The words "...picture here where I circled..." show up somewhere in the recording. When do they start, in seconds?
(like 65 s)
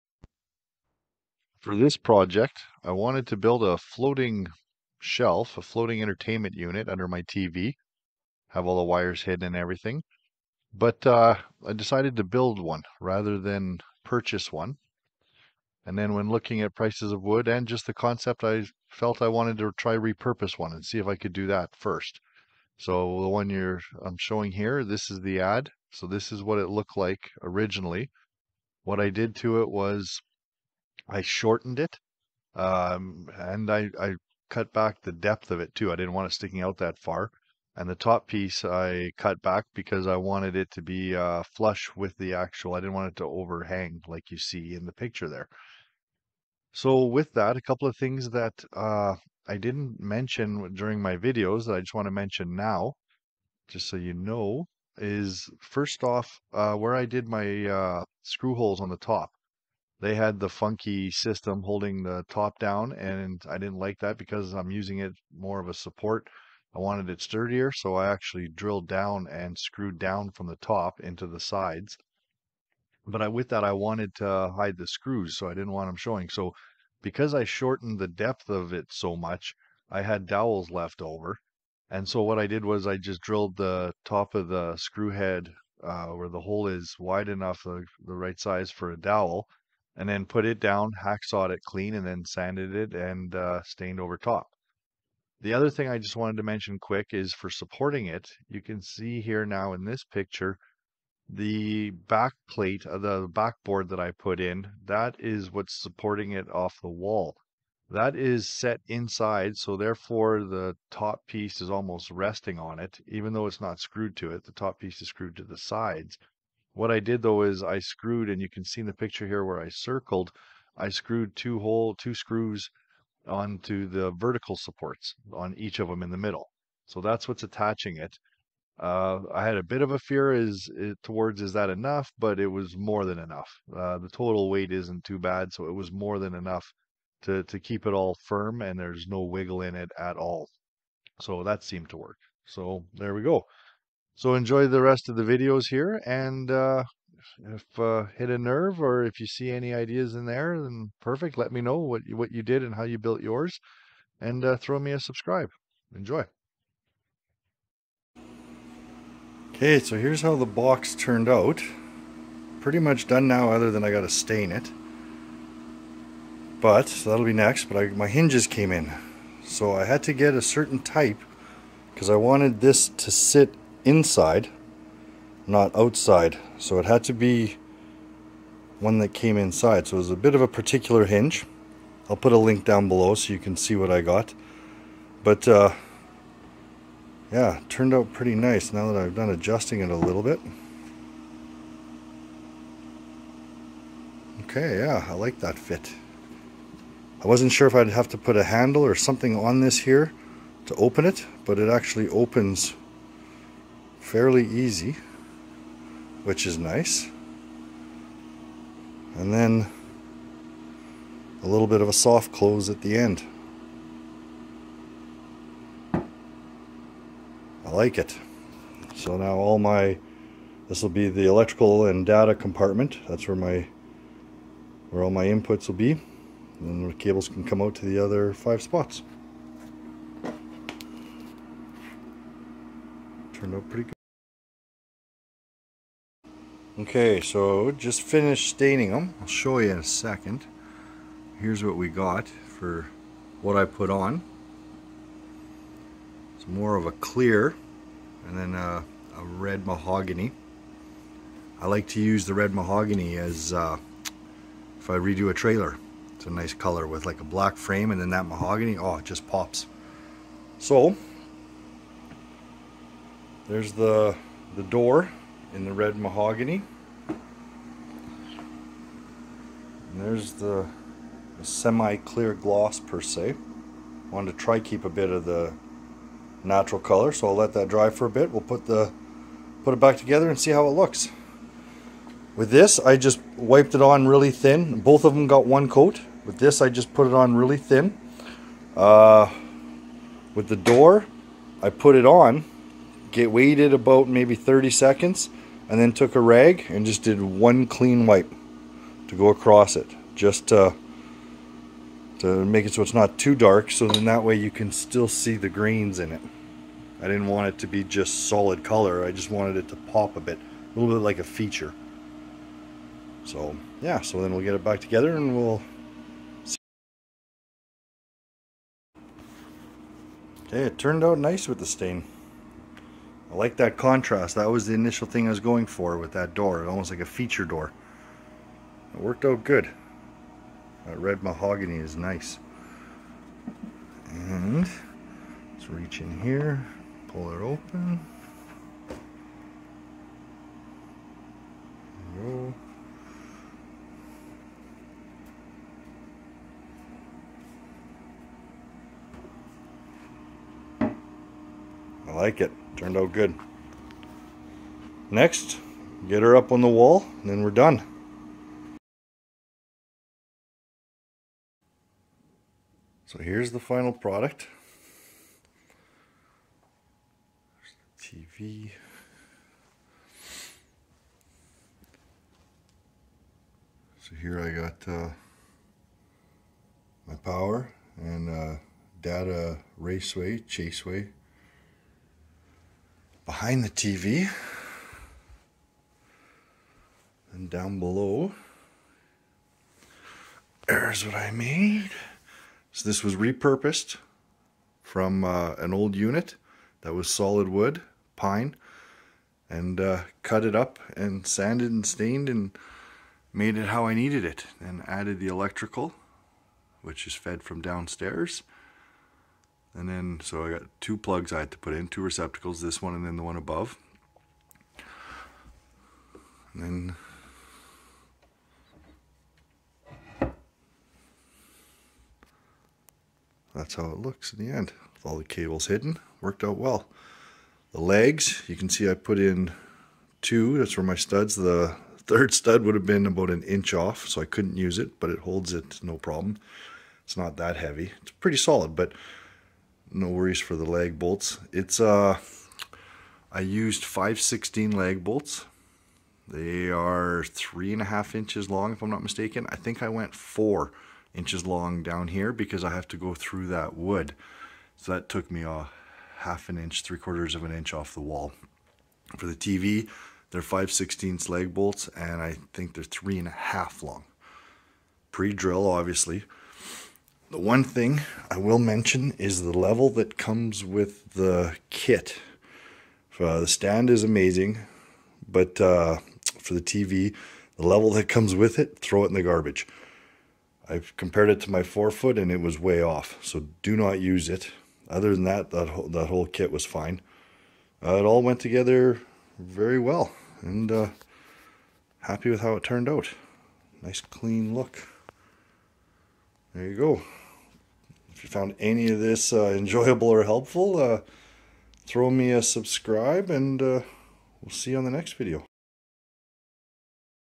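118 s.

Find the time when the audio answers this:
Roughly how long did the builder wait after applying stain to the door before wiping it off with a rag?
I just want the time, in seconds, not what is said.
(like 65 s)
294 s.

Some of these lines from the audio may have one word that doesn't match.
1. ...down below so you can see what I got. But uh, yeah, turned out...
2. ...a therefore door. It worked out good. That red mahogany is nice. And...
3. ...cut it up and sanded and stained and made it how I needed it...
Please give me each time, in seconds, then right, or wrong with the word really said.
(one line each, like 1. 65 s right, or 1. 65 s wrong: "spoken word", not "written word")
1. 182 s right
2. 326 s wrong: "feature", not "therefore"
3. 400 s right.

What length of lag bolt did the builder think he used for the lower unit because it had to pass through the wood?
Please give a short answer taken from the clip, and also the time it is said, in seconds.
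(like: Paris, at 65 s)
4 inches, at 450 s.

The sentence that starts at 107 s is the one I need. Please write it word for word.
That is set inside, so therefore the top piece is almost resting on it, even though it's not screwed to it.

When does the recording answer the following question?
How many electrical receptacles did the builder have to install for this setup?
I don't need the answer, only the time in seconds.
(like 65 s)
411 s.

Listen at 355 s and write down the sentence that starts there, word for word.
Next, get her up on the wall, and then we're done.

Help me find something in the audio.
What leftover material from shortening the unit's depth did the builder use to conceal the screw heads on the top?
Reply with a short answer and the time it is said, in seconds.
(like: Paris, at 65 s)
dowels, at 80 s.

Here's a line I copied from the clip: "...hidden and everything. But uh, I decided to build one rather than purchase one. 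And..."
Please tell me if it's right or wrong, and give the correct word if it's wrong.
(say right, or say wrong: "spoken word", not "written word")
right.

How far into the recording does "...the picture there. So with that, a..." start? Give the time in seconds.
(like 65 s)
44 s.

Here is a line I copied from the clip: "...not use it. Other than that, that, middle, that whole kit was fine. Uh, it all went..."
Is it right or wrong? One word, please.
wrong.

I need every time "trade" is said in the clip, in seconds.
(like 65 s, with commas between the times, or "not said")
not said.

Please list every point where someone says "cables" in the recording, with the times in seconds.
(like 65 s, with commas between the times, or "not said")
226 s, 425 s.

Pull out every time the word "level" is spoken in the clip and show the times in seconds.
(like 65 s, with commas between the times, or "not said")
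469 s, 477 s.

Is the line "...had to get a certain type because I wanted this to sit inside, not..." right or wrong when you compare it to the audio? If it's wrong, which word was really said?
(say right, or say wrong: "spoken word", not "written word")
right.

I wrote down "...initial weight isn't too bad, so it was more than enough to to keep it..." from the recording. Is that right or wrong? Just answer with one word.
wrong.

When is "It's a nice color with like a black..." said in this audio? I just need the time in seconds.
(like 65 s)
256 s.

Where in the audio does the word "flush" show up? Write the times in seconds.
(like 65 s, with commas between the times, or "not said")
41 s.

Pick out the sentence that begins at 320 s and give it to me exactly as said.
Okay, it turned out nice with the stain.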